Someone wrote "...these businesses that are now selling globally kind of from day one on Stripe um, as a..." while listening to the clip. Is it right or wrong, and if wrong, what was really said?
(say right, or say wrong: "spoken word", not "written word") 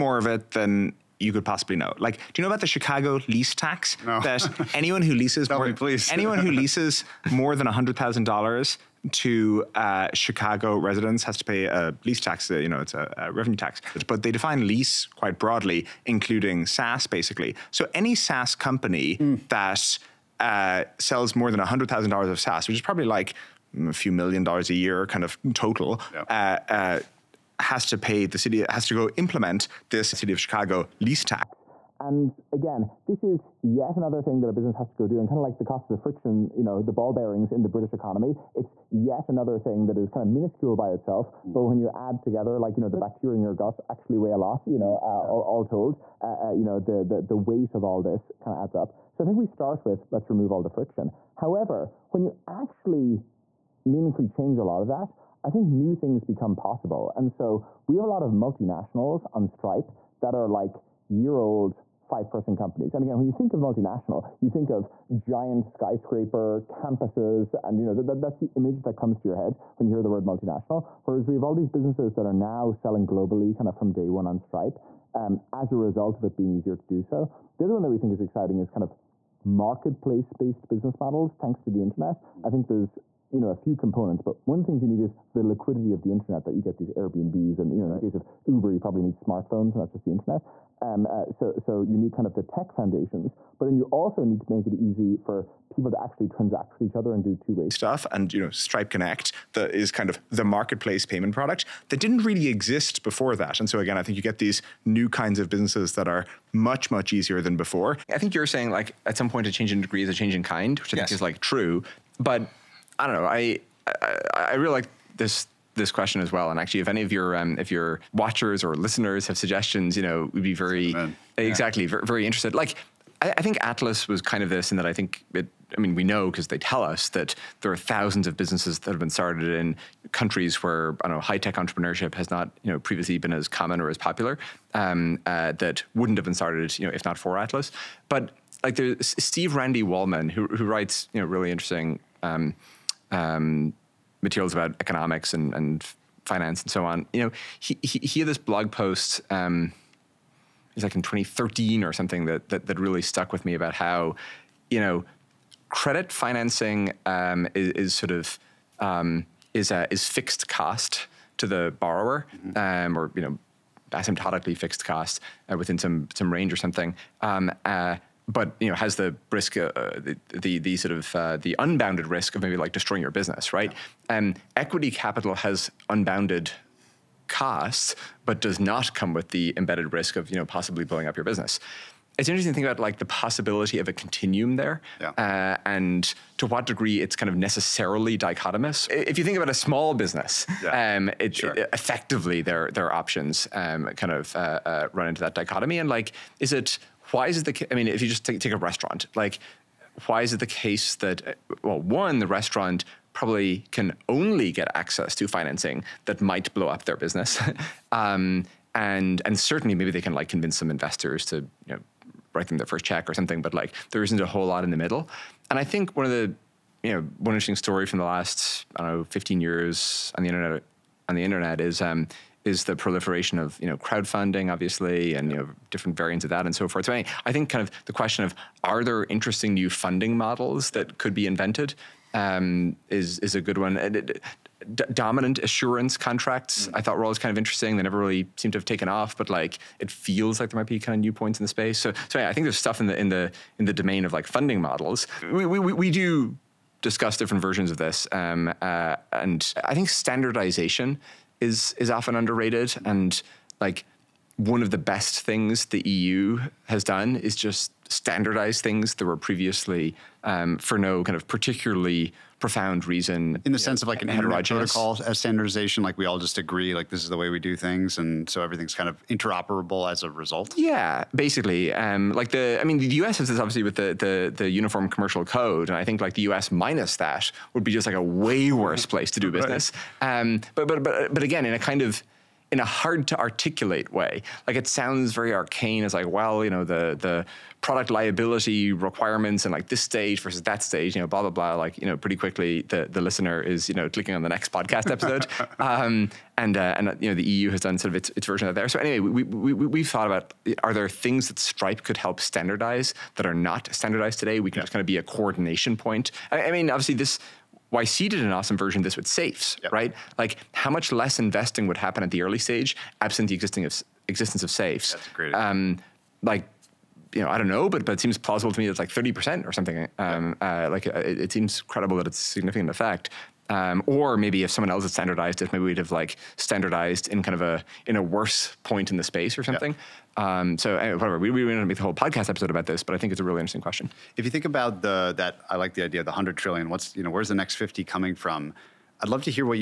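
right.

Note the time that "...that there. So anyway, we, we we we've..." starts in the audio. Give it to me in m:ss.
4:58.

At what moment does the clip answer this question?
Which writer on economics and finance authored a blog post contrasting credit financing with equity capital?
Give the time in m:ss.
2:19.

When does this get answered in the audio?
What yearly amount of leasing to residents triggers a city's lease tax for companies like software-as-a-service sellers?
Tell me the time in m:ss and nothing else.
0:07.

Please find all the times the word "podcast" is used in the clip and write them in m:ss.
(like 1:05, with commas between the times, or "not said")
4:54, 5:31.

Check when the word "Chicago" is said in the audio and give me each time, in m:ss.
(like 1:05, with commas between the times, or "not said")
0:02, 0:10, 0:30.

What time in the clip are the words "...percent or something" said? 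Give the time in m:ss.
5:19.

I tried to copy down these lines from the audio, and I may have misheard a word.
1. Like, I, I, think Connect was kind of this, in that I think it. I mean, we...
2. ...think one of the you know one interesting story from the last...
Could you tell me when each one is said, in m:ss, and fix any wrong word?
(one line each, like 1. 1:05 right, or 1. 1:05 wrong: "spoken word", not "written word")
1. 2:02 wrong: "Atlas", not "Connect"
2. 3:35 right.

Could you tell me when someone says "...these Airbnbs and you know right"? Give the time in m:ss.
1:26.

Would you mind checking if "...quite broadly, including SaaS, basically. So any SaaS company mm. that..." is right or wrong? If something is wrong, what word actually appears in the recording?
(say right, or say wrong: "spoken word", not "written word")
right.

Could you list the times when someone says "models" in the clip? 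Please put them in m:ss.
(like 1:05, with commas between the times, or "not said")
1:20, 3:50, 4:04.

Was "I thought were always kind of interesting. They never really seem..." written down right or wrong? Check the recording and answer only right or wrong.
right.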